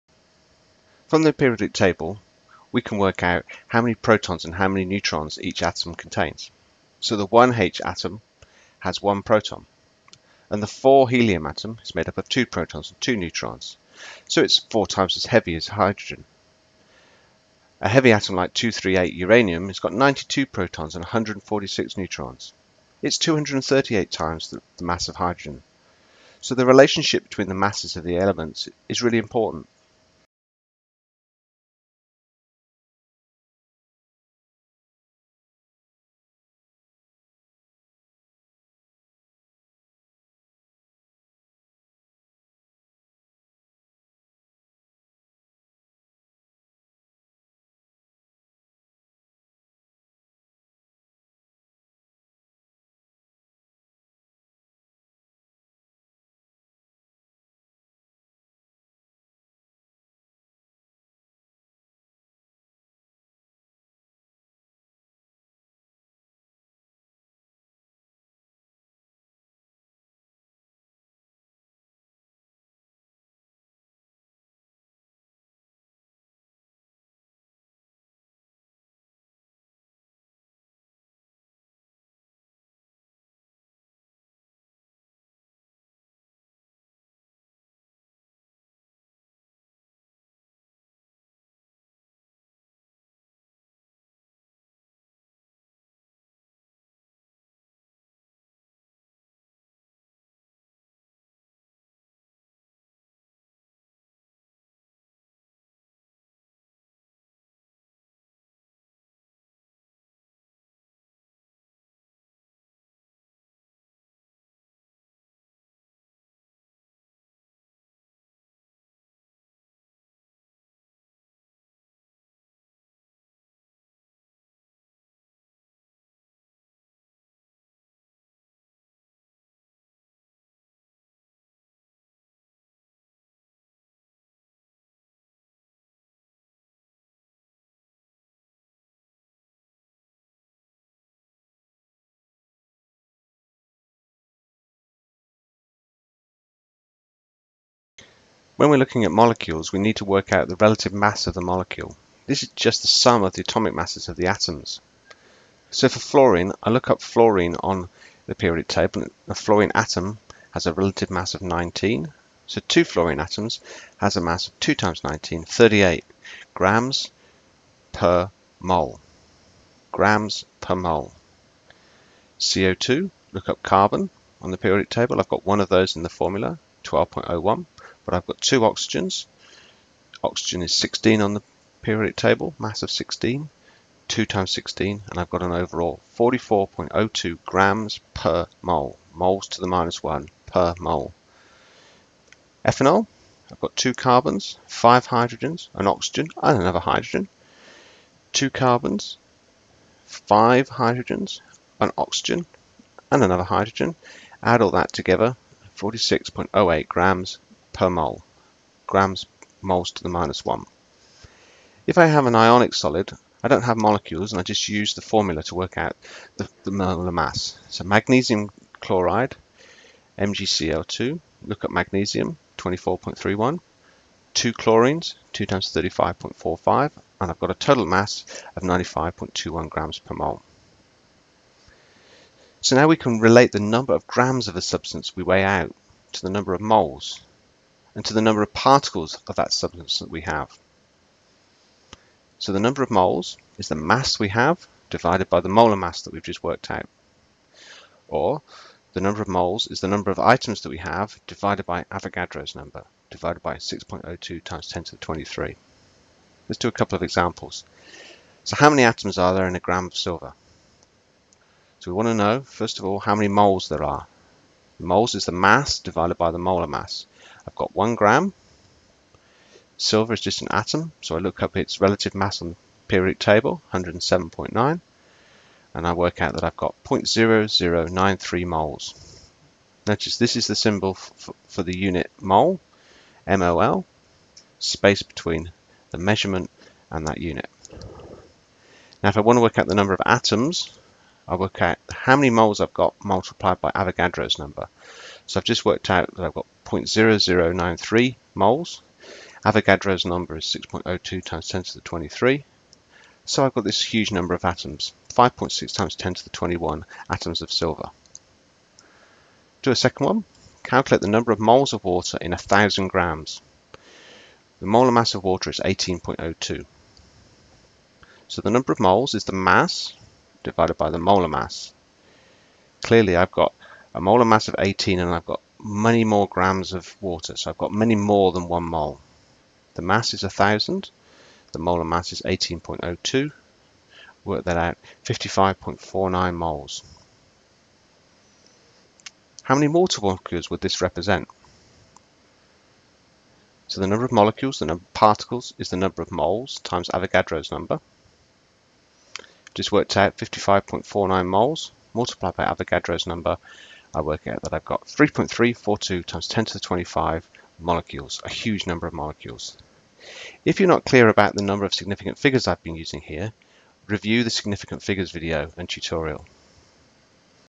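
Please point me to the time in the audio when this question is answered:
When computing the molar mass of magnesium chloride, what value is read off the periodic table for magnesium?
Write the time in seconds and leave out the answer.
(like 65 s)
222 s.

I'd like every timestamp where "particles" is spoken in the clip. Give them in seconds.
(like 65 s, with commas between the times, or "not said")
238 s, 344 s.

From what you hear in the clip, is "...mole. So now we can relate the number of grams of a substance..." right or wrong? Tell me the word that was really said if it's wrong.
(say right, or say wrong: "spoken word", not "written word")
right.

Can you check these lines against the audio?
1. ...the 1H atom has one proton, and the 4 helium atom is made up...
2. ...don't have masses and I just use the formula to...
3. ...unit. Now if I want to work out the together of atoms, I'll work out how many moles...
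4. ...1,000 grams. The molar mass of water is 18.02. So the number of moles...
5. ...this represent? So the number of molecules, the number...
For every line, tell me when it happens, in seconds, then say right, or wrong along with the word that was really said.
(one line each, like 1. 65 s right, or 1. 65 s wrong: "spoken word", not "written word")
1. 7 s right
2. 213 s wrong: "molecules", not "masses"
3. 287 s wrong: "number", not "together"
4. 312 s right
5. 340 s right.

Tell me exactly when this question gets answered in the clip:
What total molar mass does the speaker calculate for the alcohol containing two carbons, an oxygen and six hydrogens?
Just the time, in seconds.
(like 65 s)
205 s.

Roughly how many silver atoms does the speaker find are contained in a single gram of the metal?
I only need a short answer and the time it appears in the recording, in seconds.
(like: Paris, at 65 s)
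5.6 x 10^21, at 305 s.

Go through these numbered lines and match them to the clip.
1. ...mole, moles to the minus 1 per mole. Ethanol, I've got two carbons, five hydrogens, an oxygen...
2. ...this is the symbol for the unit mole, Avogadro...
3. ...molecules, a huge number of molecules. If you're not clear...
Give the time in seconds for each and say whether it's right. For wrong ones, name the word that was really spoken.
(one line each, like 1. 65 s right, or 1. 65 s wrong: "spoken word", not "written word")
1. 188 s right
2. 280 s wrong: "MOL", not "Avogadro"
3. 357 s right.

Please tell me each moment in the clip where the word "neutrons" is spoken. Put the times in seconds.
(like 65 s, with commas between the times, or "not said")
4 s, 13 s, 21 s.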